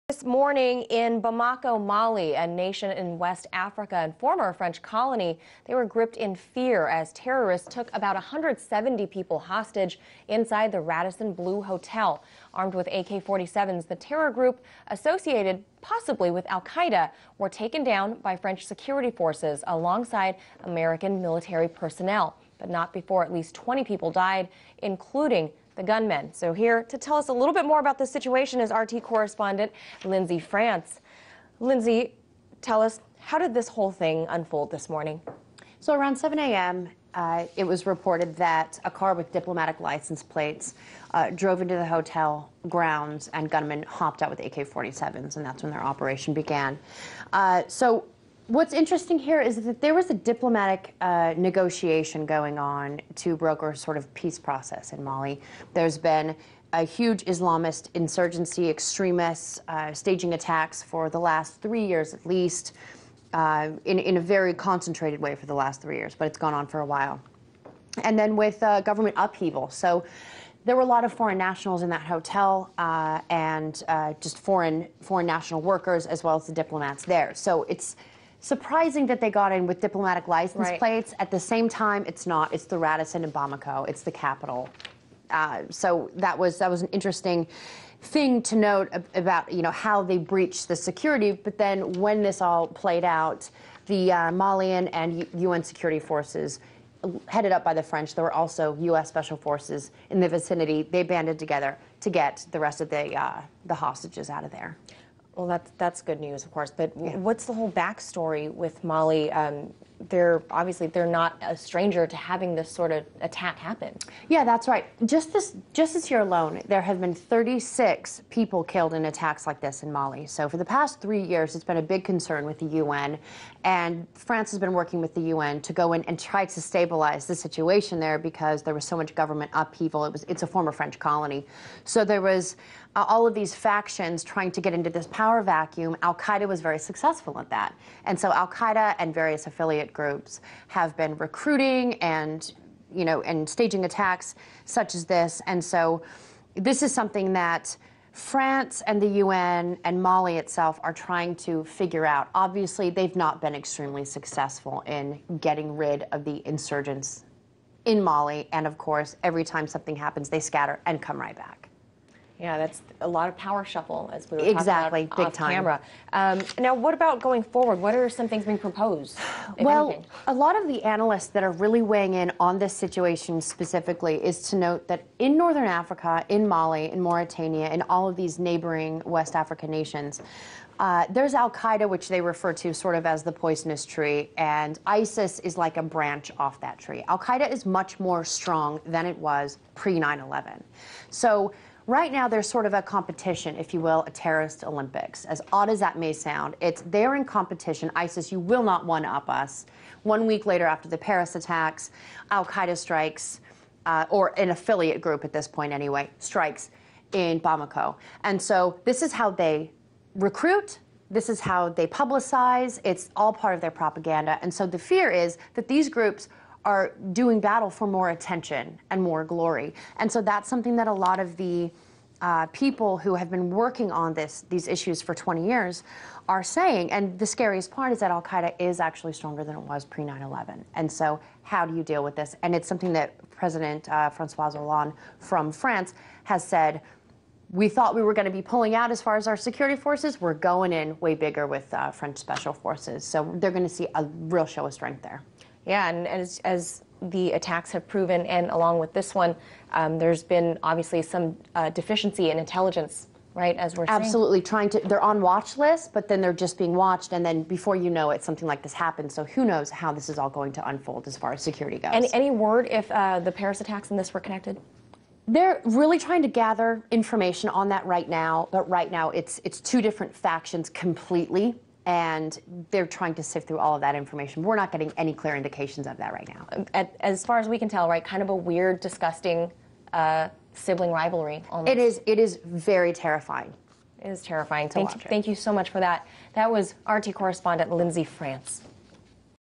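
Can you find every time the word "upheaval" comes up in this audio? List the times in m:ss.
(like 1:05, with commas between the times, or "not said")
1:09, 2:09.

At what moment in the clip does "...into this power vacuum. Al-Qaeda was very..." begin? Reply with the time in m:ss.
2:14.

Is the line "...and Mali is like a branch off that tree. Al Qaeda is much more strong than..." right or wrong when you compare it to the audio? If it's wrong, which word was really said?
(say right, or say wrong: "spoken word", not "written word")
wrong: "ISIS", not "Mali".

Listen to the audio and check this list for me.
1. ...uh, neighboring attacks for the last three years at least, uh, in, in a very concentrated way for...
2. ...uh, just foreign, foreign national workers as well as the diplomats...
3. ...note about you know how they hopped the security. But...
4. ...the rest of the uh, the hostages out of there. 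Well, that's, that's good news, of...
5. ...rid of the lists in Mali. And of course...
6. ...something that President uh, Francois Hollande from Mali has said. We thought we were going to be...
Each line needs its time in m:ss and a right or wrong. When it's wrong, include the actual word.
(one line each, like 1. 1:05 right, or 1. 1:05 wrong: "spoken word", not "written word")
1. 0:59 wrong: "staging", not "neighboring"
2. 1:13 right
3. 1:28 wrong: "breached", not "hopped"
4. 1:42 right
5. 2:35 wrong: "insurgents", not "lists"
6. 3:52 wrong: "France", not "Mali".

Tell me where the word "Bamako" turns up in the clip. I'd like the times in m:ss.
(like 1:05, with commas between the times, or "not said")
0:01, 1:23, 3:27.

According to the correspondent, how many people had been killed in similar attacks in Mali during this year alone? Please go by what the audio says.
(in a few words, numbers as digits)
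36.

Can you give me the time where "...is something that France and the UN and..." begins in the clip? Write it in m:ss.
2:26.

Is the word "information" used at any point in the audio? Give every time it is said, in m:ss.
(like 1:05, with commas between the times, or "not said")
4:26, 4:33.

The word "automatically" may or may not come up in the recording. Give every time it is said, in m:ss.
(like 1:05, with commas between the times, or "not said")
not said.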